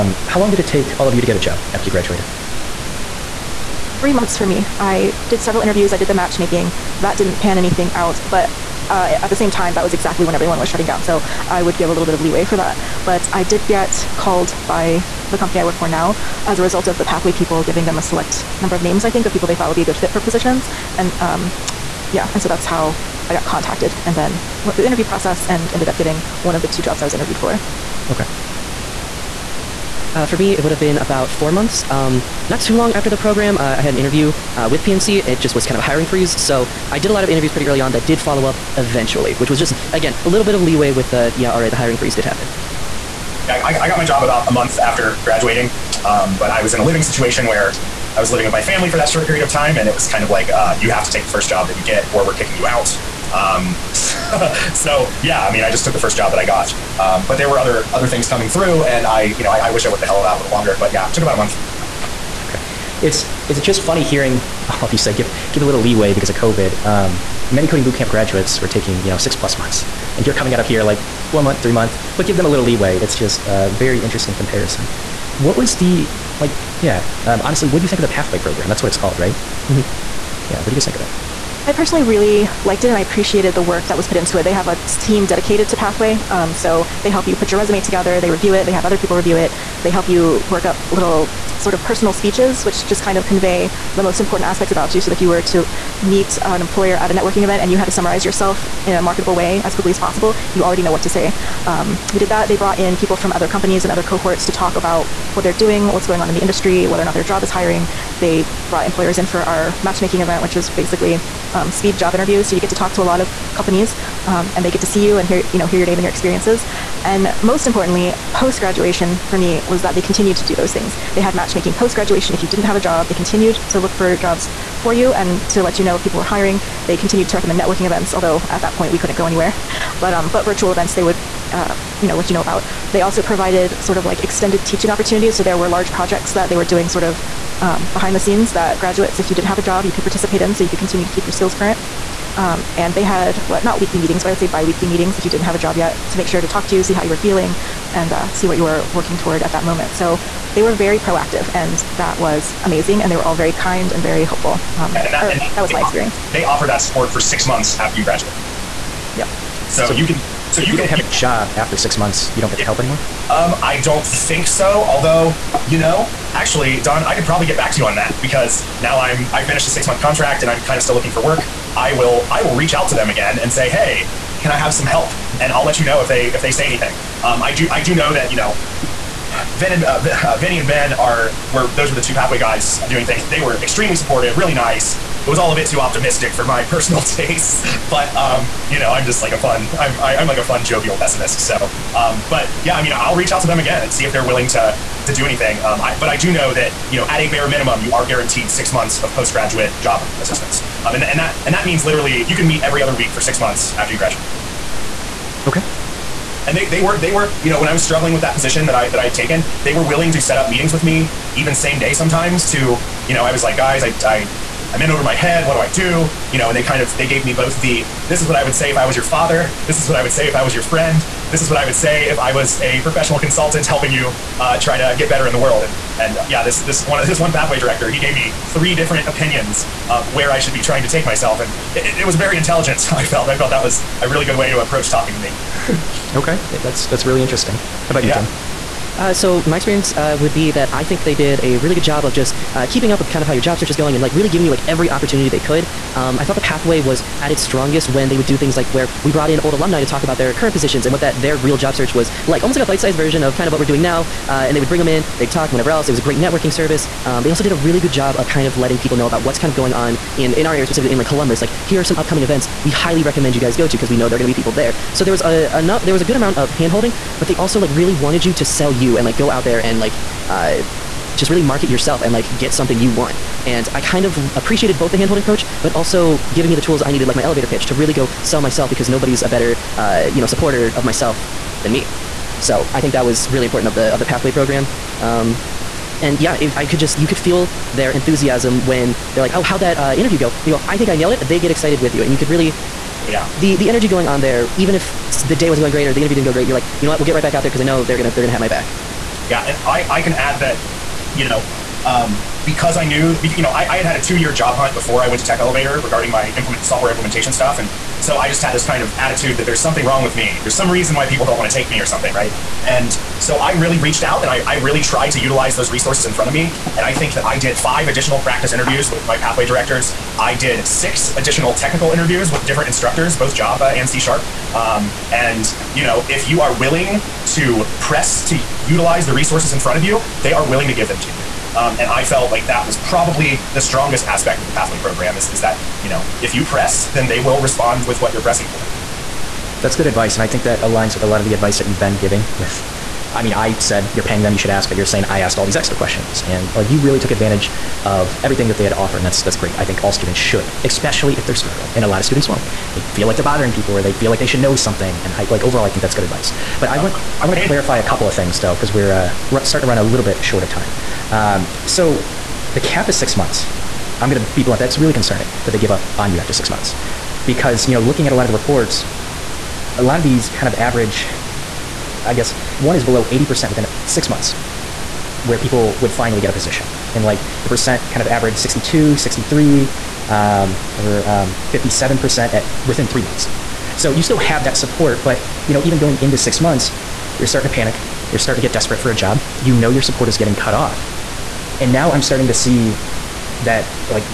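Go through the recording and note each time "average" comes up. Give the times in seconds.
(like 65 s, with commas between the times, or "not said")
370 s, 378 s.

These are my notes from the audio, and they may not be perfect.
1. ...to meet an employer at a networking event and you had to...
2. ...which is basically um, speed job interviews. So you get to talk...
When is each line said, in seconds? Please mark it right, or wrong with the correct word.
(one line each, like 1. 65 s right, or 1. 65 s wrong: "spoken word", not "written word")
1. 95 s right
2. 110 s right.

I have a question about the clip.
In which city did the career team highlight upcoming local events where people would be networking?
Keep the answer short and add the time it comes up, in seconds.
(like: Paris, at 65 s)
Columbus, at 261 s.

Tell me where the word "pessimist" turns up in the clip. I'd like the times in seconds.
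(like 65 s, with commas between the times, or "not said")
190 s.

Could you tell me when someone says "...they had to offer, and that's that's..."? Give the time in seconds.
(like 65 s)
348 s.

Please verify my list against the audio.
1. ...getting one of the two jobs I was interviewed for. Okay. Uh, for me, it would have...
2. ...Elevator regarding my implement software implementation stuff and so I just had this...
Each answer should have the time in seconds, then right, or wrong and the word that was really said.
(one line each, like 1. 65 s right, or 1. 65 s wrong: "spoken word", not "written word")
1. 25 s right
2. 305 s right.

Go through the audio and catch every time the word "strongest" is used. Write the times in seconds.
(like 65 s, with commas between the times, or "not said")
247 s, 333 s.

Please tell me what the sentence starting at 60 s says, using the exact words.
But yeah, took about a month.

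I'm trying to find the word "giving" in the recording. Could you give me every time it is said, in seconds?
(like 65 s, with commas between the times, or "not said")
17 s, 244 s, 276 s, 341 s.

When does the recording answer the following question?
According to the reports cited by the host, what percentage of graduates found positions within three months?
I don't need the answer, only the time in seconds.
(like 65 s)
381 s.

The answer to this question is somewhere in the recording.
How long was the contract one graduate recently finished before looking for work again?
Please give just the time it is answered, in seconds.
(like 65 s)
169 s.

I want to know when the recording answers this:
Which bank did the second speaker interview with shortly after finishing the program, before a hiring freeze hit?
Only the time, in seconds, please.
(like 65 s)
34 s.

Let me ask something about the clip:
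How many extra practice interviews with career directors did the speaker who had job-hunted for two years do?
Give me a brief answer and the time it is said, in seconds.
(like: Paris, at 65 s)
5, at 317 s.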